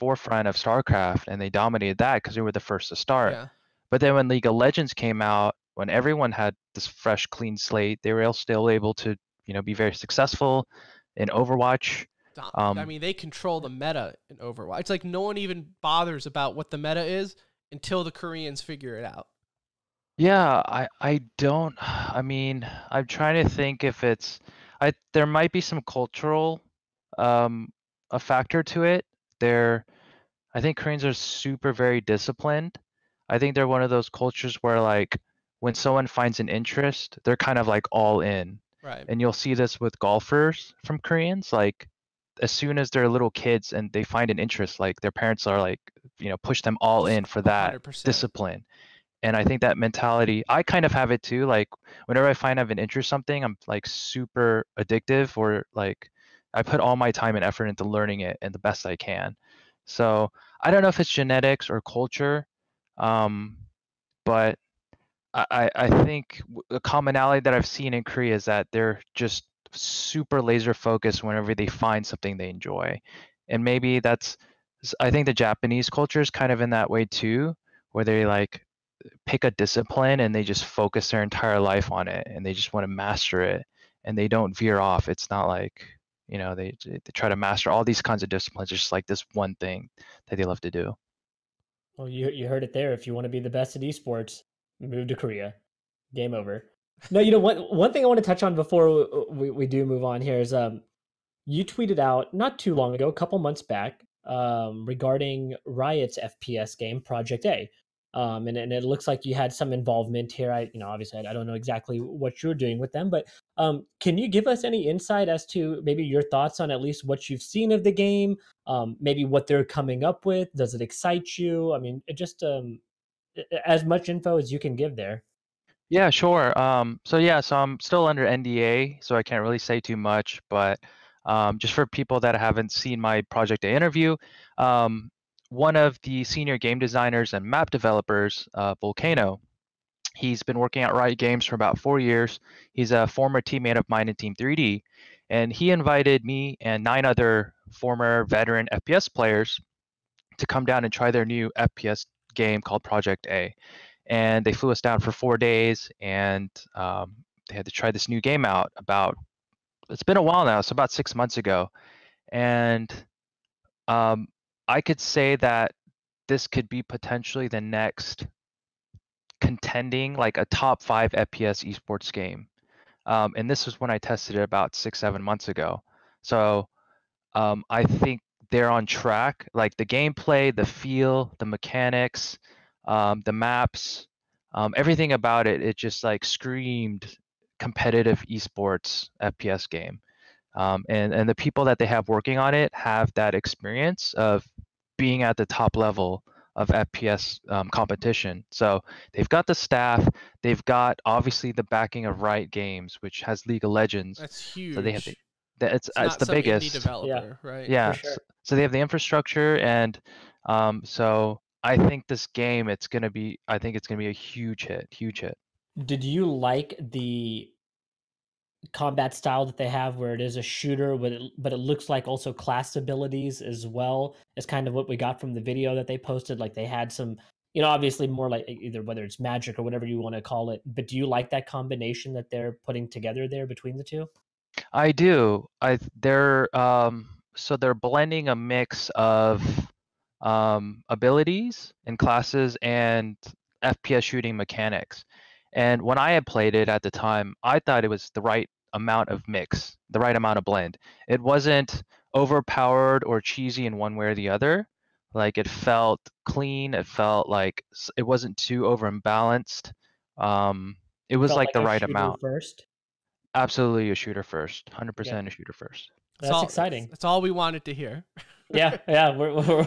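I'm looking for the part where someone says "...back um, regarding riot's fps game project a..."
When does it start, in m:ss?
1:43.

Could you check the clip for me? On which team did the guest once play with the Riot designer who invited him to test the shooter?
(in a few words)
Team 3D.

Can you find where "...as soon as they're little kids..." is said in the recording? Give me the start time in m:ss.
0:42.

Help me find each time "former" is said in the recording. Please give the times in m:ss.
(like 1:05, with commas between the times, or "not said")
2:23, 2:27.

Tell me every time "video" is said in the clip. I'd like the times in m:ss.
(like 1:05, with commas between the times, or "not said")
3:45.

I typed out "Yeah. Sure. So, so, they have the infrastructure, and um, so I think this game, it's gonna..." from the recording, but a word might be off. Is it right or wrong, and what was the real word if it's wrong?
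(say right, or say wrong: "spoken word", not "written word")
right.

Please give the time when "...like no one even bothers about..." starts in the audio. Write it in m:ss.
0:14.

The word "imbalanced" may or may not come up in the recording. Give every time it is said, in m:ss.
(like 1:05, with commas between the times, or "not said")
4:18.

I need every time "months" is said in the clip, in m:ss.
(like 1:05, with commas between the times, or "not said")
1:43, 2:41, 2:55.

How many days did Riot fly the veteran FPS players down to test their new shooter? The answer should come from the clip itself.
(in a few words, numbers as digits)
4.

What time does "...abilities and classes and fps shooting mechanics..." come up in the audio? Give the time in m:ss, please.
4:00.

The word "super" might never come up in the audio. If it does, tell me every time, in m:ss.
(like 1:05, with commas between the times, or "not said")
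0:31, 0:53, 1:09.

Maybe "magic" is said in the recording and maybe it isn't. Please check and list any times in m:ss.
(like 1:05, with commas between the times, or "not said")
3:49.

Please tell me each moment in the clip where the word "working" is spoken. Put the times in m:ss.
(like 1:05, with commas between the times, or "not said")
2:20, 3:12.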